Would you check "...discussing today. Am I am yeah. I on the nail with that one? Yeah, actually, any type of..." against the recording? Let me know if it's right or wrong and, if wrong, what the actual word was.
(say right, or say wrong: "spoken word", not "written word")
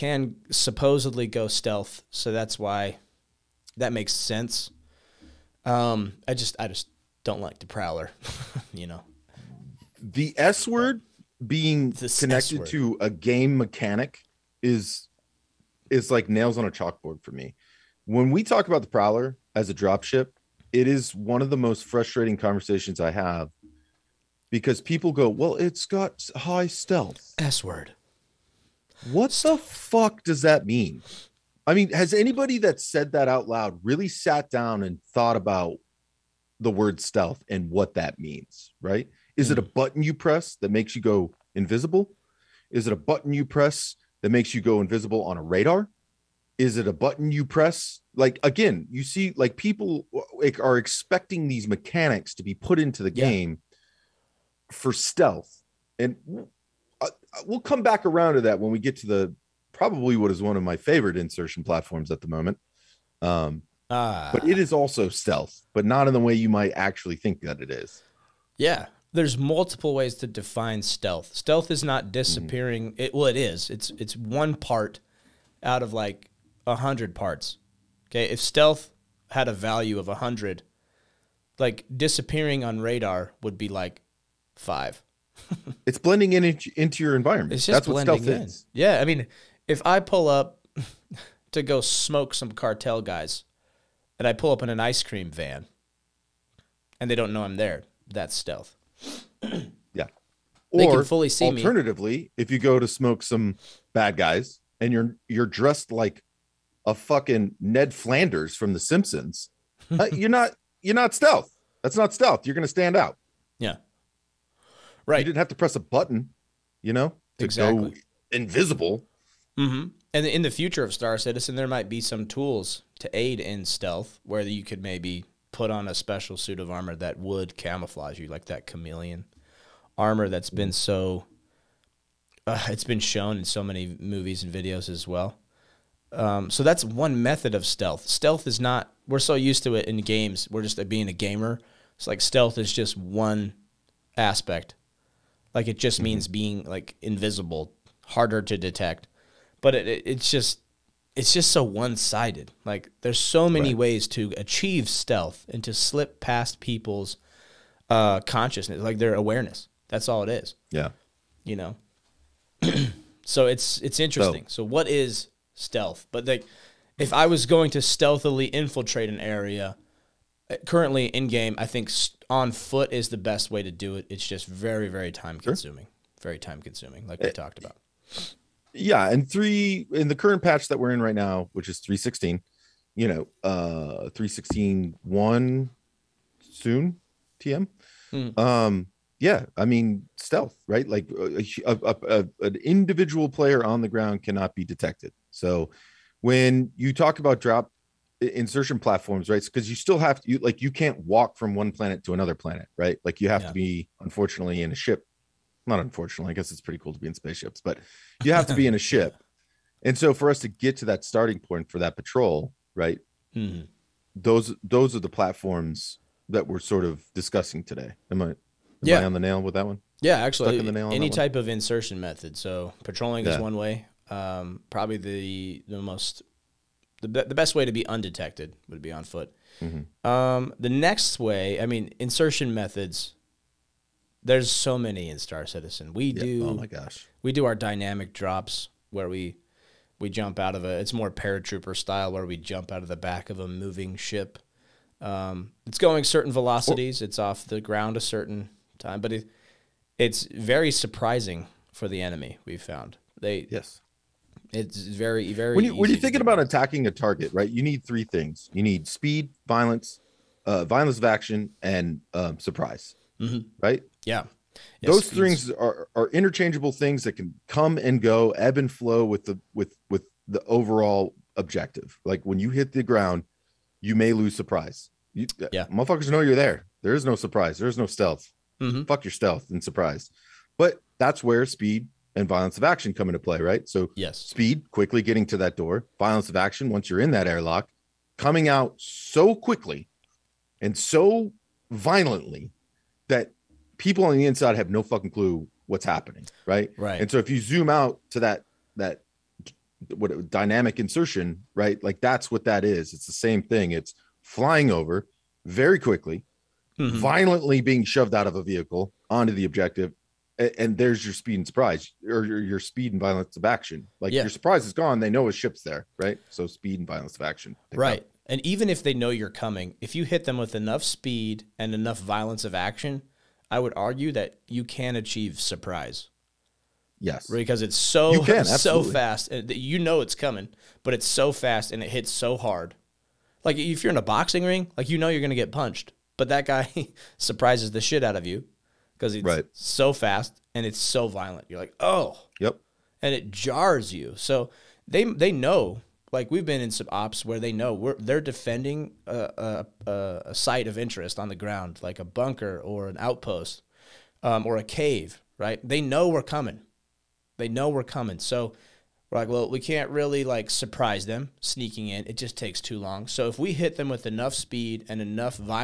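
right.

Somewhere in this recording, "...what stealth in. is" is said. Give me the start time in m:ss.
1:28.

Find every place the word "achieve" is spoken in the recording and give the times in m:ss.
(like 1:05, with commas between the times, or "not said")
2:34, 5:24.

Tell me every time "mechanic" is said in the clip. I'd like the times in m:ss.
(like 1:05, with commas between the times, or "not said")
0:13, 0:51.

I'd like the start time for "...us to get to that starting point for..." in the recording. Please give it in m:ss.
3:30.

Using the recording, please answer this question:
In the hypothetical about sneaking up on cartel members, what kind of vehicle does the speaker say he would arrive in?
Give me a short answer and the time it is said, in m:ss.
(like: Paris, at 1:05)
Ice cream van, at 1:34.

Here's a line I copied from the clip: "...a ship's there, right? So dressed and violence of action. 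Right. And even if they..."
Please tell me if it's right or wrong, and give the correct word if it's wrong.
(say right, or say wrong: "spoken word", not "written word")
wrong: "speed", not "dressed".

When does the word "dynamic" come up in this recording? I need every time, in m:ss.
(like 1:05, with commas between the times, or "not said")
3:57, 5:00.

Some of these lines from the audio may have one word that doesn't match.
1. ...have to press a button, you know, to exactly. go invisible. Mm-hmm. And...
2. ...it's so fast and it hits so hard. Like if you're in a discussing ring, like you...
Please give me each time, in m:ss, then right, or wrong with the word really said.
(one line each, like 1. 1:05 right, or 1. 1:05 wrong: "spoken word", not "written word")
1. 1:55 right
2. 5:30 wrong: "boxing", not "discussing".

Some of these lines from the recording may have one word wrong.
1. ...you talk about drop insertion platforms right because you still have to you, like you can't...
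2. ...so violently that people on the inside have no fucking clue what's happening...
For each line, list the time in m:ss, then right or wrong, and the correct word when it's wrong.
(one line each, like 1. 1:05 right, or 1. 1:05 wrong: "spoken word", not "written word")
1. 3:16 right
2. 4:50 right.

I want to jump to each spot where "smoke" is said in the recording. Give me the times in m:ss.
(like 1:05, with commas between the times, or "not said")
1:31, 1:42.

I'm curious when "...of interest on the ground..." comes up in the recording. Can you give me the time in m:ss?
5:50.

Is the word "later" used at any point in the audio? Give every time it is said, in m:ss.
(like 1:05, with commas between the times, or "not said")
not said.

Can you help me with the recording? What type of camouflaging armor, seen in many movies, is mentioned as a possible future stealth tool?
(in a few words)
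Chameleon armor.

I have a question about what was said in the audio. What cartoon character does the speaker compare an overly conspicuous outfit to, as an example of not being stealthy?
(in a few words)
Ned Flanders.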